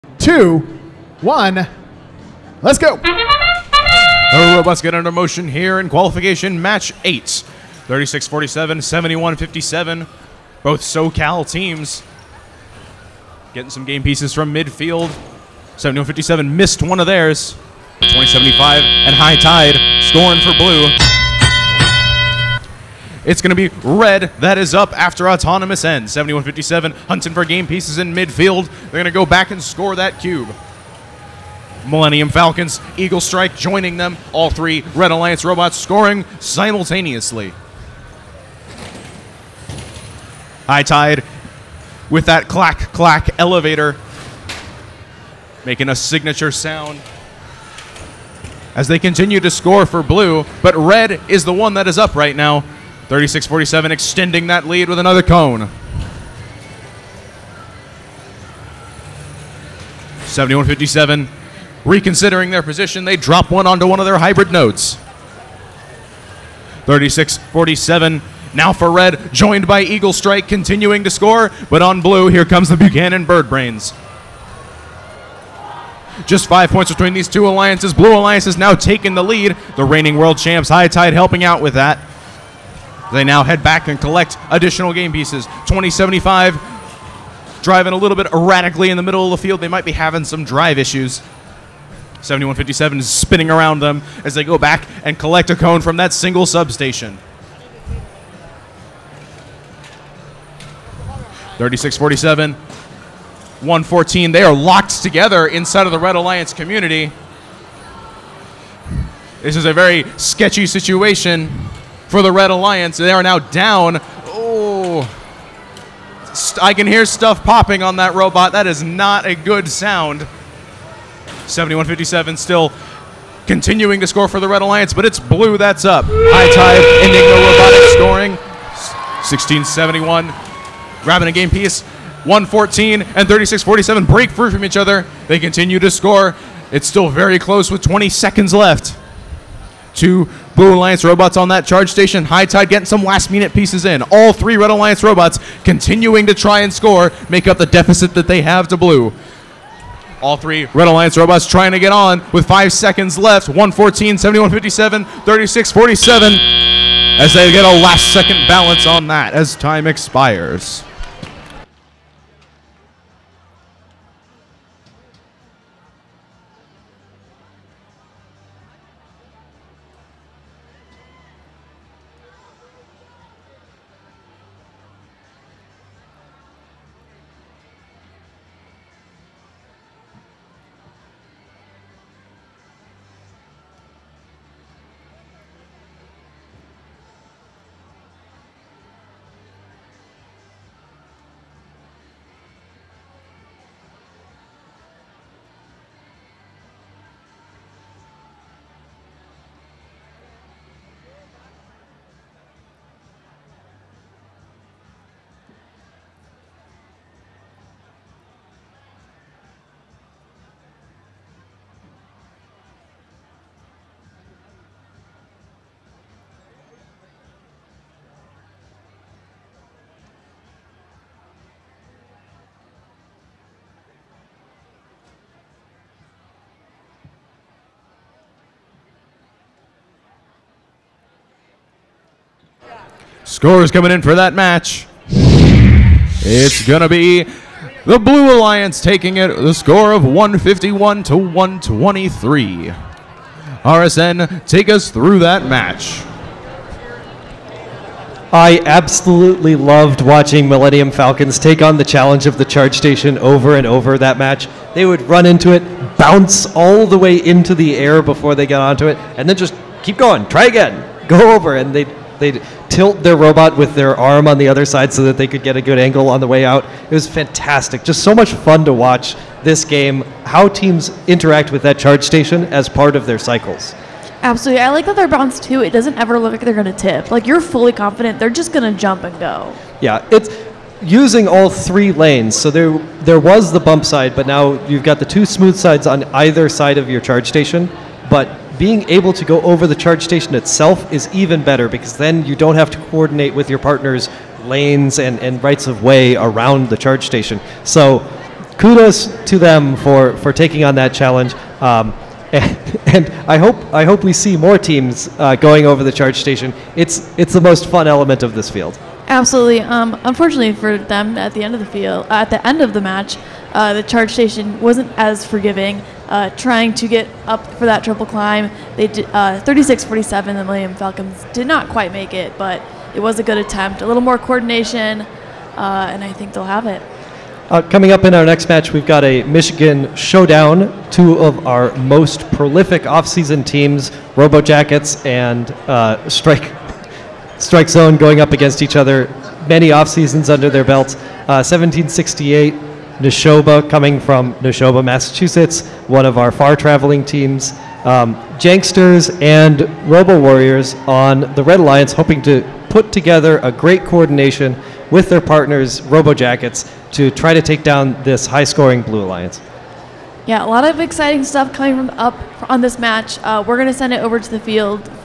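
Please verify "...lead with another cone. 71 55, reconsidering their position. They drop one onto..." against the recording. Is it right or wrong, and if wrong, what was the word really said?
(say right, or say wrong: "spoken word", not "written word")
wrong: "57", not "55".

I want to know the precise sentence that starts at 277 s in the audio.
Like you're fully confident they're just going to jump and go.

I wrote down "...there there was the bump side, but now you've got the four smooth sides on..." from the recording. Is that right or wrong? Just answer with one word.
wrong.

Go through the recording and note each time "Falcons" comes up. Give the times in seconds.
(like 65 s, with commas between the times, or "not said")
32 s, 250 s, 320 s.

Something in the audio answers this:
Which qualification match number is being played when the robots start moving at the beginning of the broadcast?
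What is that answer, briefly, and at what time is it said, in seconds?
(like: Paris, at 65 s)
8, at 7 s.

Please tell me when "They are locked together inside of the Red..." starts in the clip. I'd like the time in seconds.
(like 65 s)
104 s.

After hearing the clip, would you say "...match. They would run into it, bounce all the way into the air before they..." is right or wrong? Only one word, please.
right.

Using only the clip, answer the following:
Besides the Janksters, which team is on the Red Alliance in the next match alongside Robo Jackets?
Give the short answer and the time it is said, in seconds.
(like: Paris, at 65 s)
Robo Warriors, at 349 s.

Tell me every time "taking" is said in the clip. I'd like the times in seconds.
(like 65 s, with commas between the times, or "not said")
238 s, 300 s.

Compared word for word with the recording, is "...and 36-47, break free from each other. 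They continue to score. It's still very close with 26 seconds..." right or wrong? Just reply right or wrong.
wrong.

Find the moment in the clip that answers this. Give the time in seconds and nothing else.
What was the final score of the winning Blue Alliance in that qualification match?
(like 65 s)
240 s.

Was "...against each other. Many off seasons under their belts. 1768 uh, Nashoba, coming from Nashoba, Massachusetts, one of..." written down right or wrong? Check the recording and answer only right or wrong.
right.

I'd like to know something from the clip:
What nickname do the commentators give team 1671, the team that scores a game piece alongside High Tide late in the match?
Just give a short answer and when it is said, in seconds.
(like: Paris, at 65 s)
Buchanan Bird Brains, at 72 s.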